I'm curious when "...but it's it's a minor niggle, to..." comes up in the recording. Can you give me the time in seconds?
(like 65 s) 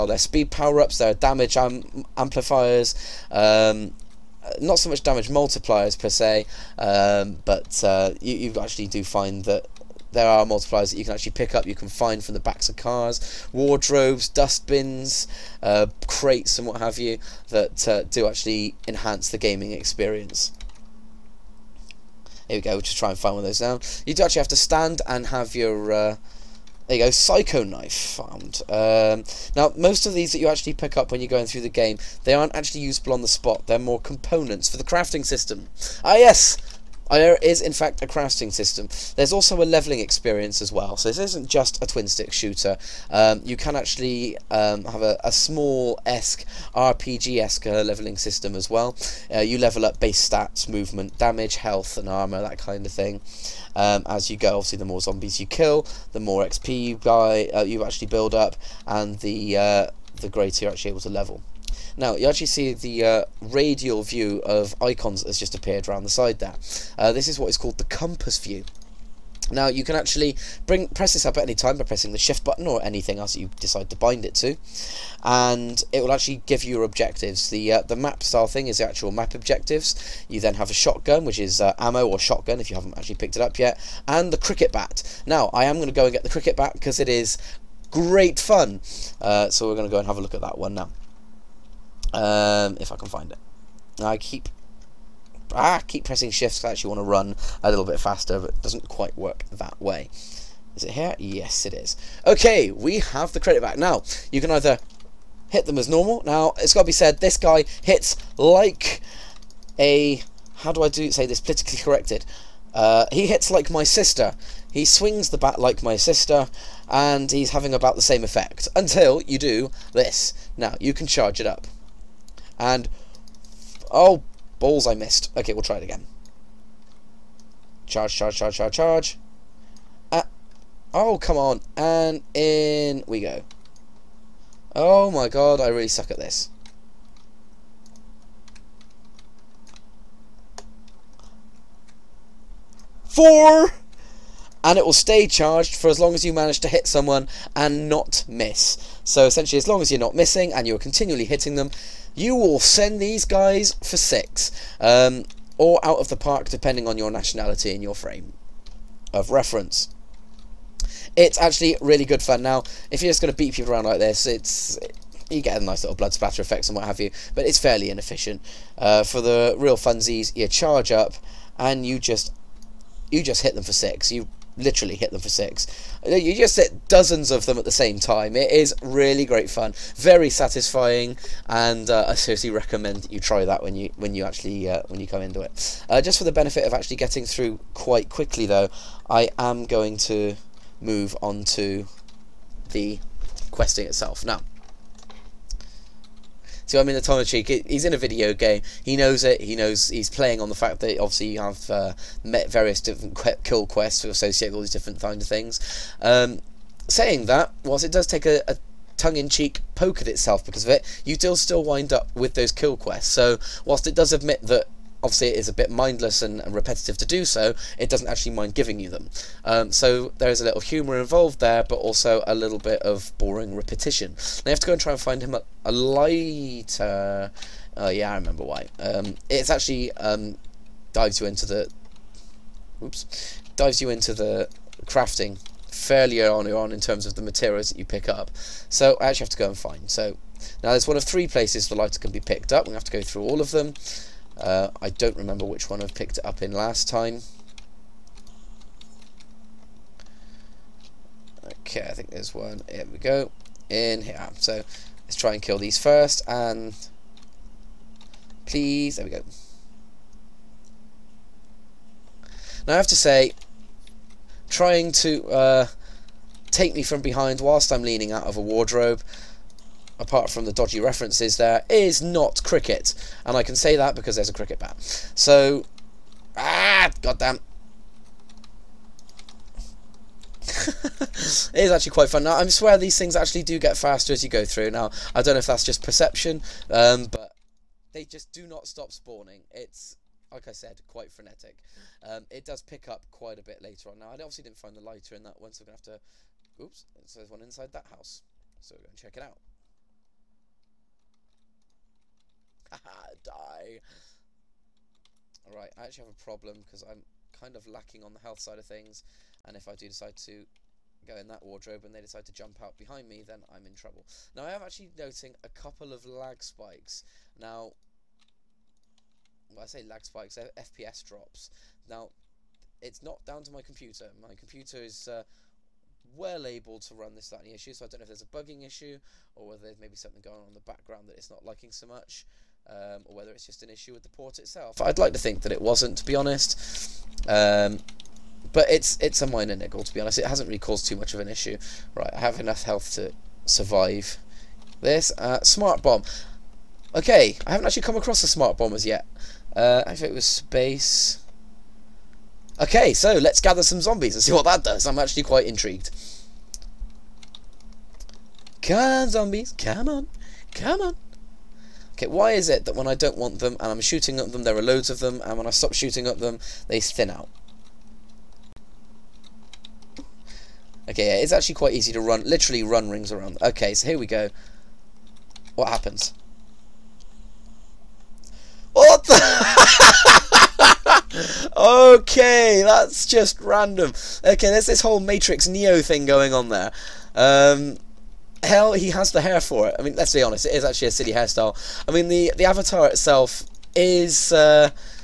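338 s.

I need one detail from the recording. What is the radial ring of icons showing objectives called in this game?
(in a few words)
Compass view.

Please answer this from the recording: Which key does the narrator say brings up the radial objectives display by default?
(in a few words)
Shift.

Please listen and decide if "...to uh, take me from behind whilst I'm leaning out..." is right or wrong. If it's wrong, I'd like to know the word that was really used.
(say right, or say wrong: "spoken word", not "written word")
right.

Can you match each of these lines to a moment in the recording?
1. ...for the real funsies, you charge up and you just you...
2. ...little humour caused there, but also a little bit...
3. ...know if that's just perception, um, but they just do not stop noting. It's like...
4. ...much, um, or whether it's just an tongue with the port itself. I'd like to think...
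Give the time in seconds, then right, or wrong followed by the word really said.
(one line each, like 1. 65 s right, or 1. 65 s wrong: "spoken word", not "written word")
1. 169 s right
2. 220 s wrong: "involved", not "caused"
3. 285 s wrong: "spawning", not "noting"
4. 331 s wrong: "issue", not "tongue".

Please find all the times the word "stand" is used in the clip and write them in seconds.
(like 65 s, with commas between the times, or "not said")
24 s.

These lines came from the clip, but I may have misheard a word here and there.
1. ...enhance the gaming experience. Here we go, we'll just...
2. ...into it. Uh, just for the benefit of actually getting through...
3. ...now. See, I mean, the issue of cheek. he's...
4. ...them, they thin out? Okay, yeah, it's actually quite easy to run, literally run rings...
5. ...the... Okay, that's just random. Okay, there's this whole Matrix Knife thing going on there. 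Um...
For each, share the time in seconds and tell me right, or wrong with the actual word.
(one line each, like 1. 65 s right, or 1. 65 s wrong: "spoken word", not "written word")
1. 18 s right
2. 185 s right
3. 194 s wrong: "tongue", not "issue"
4. 366 s right
5. 379 s wrong: "Neo", not "Knife".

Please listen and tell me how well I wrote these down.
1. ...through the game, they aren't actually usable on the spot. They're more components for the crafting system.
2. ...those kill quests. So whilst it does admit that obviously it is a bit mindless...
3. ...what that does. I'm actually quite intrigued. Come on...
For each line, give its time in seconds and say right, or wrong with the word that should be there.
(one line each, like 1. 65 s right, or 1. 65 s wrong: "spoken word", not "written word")
1. 31 s right
2. 212 s right
3. 354 s right.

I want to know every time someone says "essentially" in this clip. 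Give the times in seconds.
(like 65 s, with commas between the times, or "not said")
149 s.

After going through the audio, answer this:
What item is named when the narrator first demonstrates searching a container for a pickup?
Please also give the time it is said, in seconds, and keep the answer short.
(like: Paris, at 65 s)
Psycho Knife, at 27 s.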